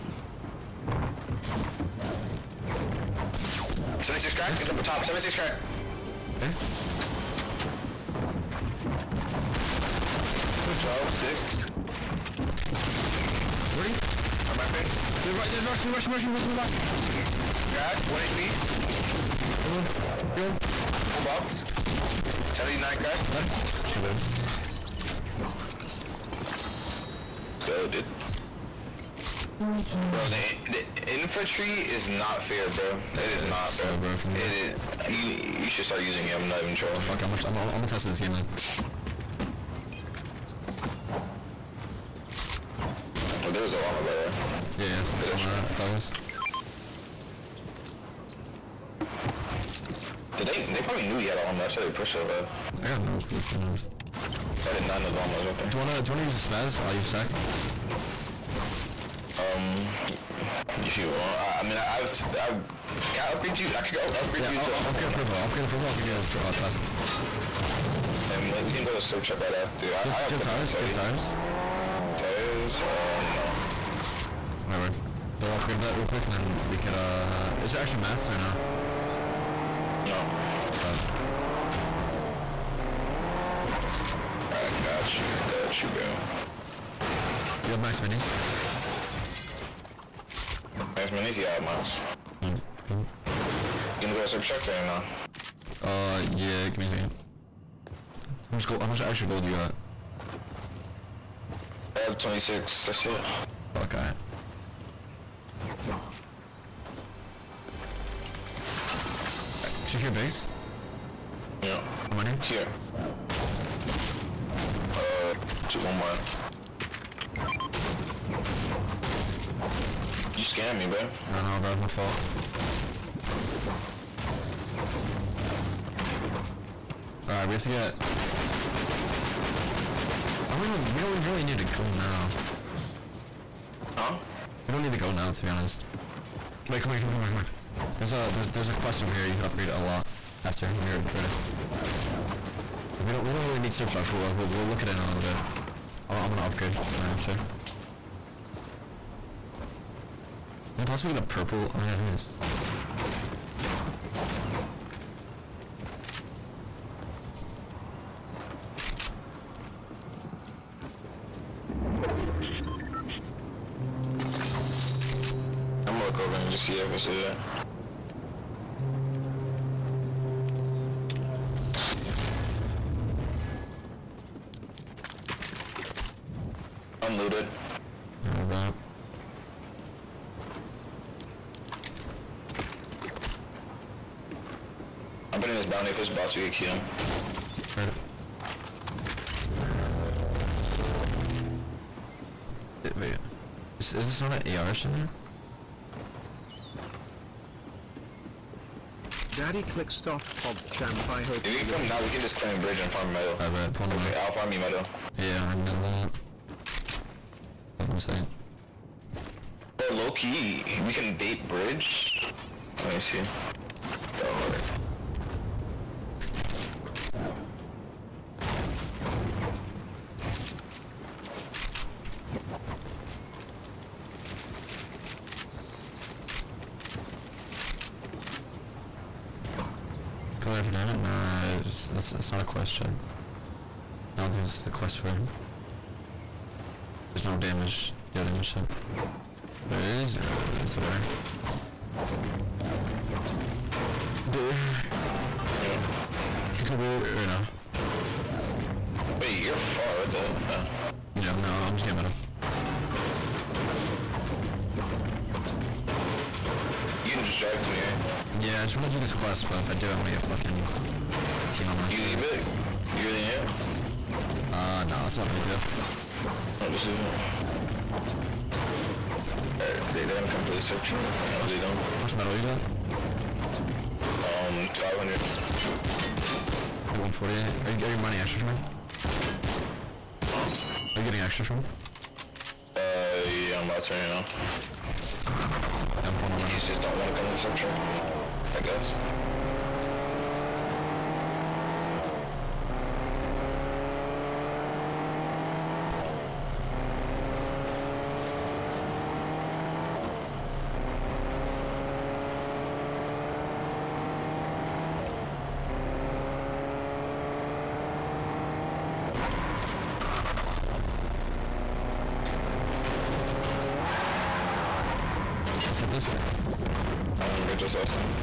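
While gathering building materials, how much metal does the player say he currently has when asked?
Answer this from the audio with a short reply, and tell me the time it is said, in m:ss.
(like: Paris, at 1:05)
500, at 4:34.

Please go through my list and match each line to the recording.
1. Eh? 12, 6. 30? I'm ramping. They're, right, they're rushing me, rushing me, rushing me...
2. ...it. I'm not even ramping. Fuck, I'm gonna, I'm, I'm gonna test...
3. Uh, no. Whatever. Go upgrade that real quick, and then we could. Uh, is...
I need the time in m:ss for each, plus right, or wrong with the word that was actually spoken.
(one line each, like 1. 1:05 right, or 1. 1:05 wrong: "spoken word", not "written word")
1. 0:06 right
2. 0:36 wrong: "trolling", not "ramping"
3. 1:12 right.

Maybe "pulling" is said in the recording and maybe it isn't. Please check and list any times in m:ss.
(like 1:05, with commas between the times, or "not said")
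3:23, 4:46.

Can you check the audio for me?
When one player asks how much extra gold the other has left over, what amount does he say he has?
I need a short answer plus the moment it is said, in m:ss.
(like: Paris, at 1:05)
26, at 1:42.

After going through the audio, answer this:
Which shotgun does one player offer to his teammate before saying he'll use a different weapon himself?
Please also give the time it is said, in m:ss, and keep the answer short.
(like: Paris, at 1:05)
spaz, at 0:56.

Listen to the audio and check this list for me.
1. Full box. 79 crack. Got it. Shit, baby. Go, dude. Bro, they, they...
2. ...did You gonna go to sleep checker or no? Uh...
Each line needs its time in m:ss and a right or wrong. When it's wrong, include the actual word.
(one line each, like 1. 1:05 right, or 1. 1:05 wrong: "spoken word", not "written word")
1. 0:20 right
2. 1:32 right.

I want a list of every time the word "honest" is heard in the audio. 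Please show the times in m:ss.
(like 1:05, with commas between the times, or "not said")
0:53, 2:15.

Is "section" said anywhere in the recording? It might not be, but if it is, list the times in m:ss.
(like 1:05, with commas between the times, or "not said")
4:30.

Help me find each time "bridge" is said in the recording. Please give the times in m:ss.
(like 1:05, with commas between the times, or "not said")
3:22, 3:31.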